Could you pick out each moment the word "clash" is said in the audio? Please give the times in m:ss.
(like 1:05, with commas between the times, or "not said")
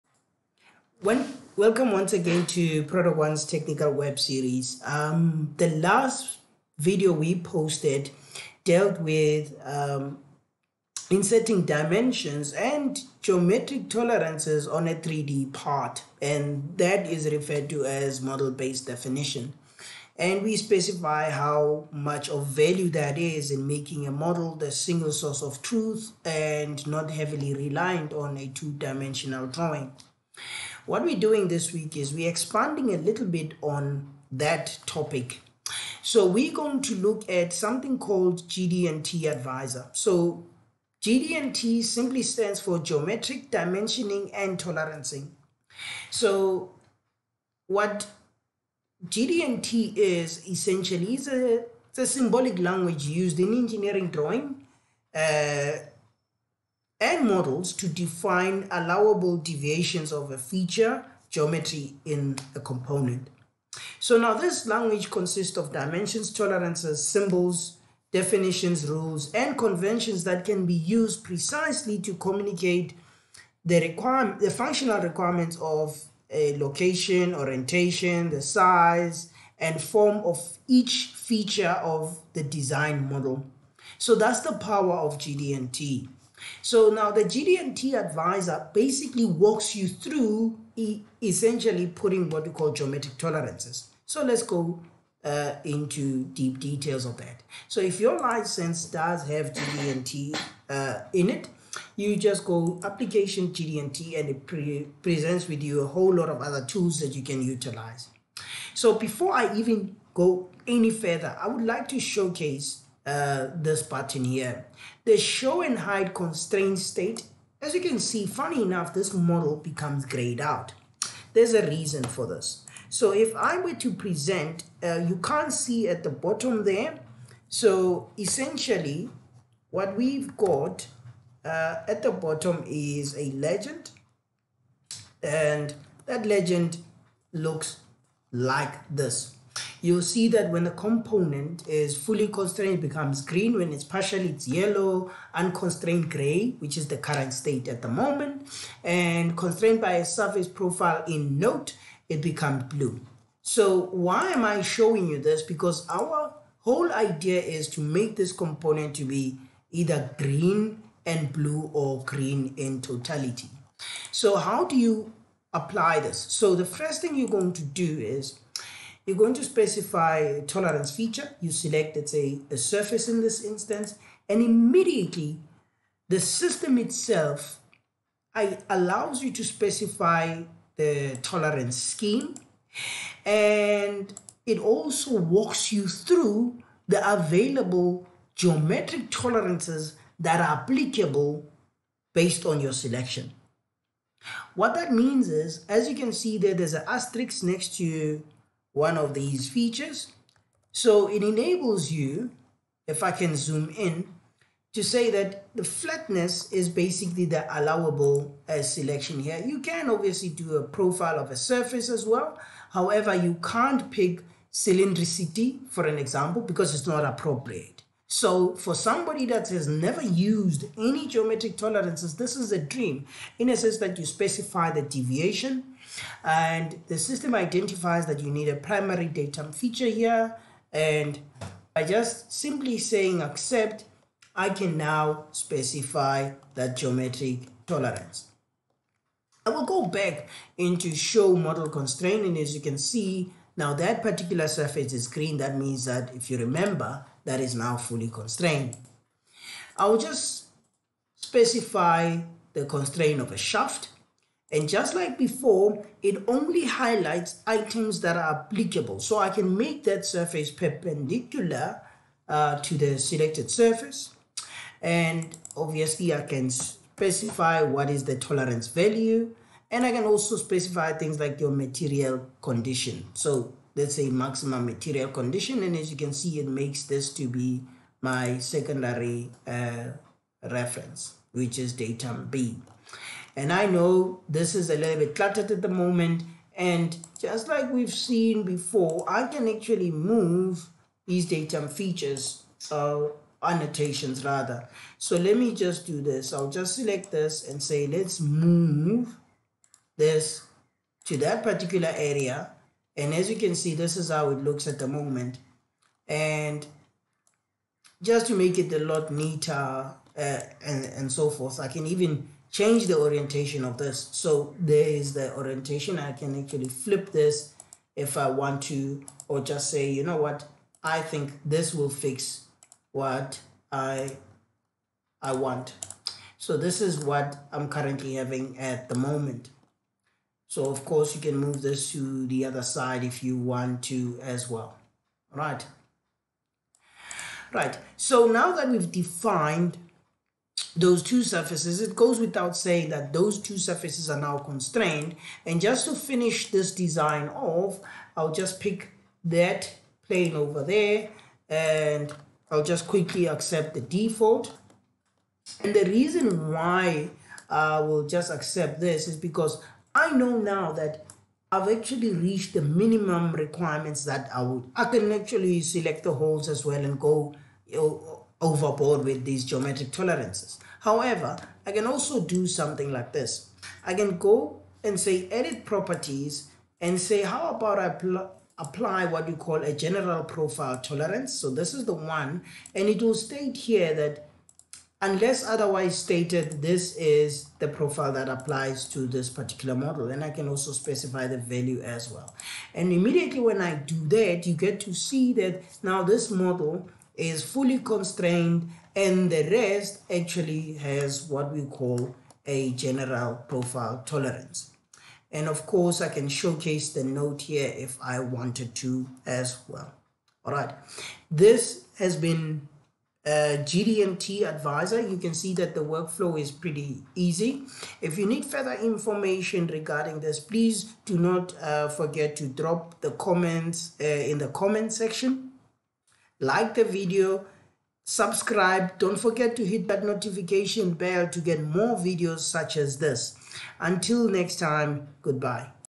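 not said.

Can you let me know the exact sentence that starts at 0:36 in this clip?
So we're going to look at something called GD&T Advisor.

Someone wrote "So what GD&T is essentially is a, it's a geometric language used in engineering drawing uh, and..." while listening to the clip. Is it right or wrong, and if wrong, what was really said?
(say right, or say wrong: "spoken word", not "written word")
wrong: "symbolic", not "geometric".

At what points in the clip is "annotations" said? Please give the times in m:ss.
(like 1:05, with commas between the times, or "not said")
4:53.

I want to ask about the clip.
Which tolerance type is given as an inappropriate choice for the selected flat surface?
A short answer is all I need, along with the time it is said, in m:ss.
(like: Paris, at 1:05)
cylindricity, at 3:34.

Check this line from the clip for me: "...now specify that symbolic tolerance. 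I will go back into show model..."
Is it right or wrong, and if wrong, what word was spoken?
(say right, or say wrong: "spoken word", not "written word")
wrong: "geometric", not "symbolic".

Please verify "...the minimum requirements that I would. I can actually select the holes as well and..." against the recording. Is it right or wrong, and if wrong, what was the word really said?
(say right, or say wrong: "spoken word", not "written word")
right.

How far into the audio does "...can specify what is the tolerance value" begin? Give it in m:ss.
4:26.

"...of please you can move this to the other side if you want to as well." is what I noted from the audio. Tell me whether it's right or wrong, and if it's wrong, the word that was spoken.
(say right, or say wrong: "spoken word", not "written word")
wrong: "course", not "please".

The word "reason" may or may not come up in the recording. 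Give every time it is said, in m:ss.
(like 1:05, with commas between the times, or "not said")
2:01, 5:55.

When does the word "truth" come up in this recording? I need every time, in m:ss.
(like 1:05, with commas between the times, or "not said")
0:25.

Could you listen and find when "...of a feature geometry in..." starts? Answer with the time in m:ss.
1:00.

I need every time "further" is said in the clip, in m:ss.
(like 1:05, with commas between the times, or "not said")
1:50, 6:58.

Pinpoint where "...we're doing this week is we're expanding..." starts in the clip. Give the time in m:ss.
0:31.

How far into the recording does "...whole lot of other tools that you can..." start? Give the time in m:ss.
1:45.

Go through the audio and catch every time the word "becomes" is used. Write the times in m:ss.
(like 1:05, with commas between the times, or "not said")
1:59, 2:22, 2:32.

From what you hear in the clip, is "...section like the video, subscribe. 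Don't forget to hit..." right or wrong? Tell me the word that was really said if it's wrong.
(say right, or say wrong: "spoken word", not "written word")
right.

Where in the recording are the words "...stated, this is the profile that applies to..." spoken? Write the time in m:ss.
6:25.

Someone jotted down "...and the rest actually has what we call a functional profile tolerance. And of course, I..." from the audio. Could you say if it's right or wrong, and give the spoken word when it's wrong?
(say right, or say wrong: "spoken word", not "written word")
wrong: "general", not "functional".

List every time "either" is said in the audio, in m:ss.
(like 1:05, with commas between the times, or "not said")
2:39.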